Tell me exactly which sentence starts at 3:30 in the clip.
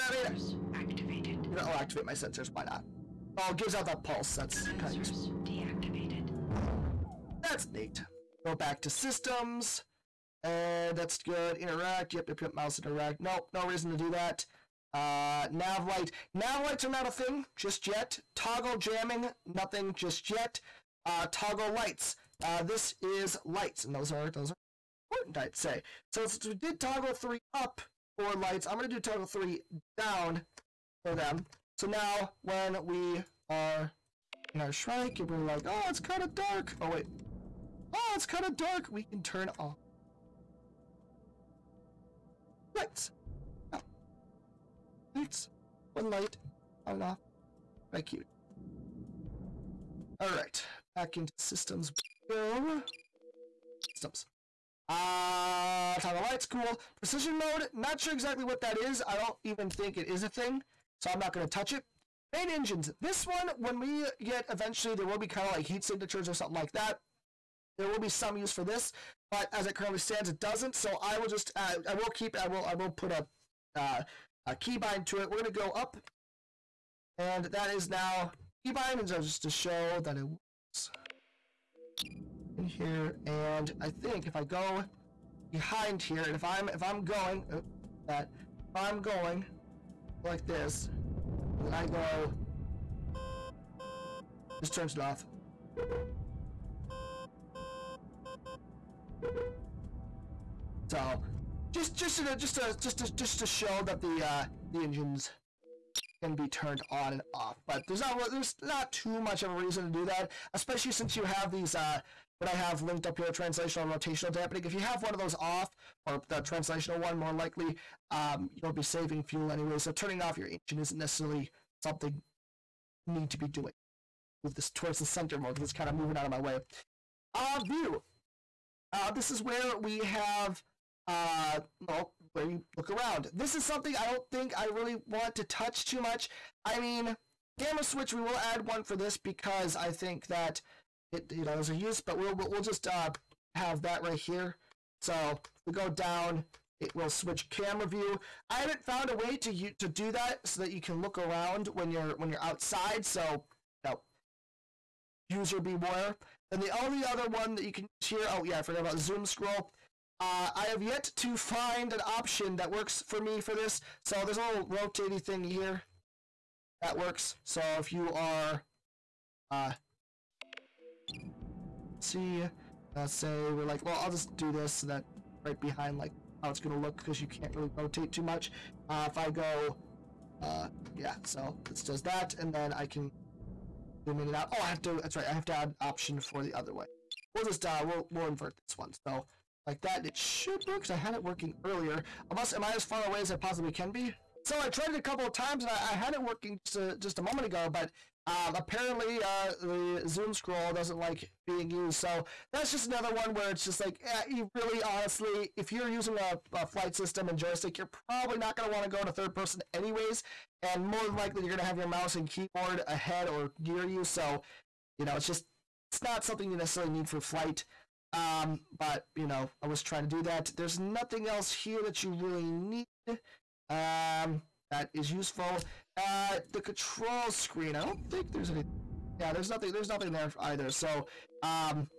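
And more than likely, you're going to have your mouse and keyboard ahead or near you.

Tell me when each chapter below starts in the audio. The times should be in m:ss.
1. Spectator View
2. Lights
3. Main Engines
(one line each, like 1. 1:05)
1. 2:06
2. 0:20
3. 1:01.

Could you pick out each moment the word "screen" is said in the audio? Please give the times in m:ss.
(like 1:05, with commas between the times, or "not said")
3:47.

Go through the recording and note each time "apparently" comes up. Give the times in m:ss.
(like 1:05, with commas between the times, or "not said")
3:18.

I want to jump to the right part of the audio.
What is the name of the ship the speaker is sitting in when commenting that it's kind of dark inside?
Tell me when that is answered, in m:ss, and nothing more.
0:34.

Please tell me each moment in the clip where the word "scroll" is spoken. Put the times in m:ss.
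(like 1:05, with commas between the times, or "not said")
2:39, 3:20.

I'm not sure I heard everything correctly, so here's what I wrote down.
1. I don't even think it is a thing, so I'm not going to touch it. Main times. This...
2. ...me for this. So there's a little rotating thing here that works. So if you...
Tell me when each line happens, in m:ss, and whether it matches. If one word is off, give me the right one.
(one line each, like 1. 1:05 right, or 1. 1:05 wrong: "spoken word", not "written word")
1. 0:59 wrong: "engines", not "times"
2. 2:43 right.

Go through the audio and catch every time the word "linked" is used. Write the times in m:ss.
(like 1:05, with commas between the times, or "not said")
1:52.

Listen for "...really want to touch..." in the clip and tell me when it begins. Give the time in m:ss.
2:14.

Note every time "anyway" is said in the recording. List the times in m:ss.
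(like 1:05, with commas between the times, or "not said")
1:59, 3:29.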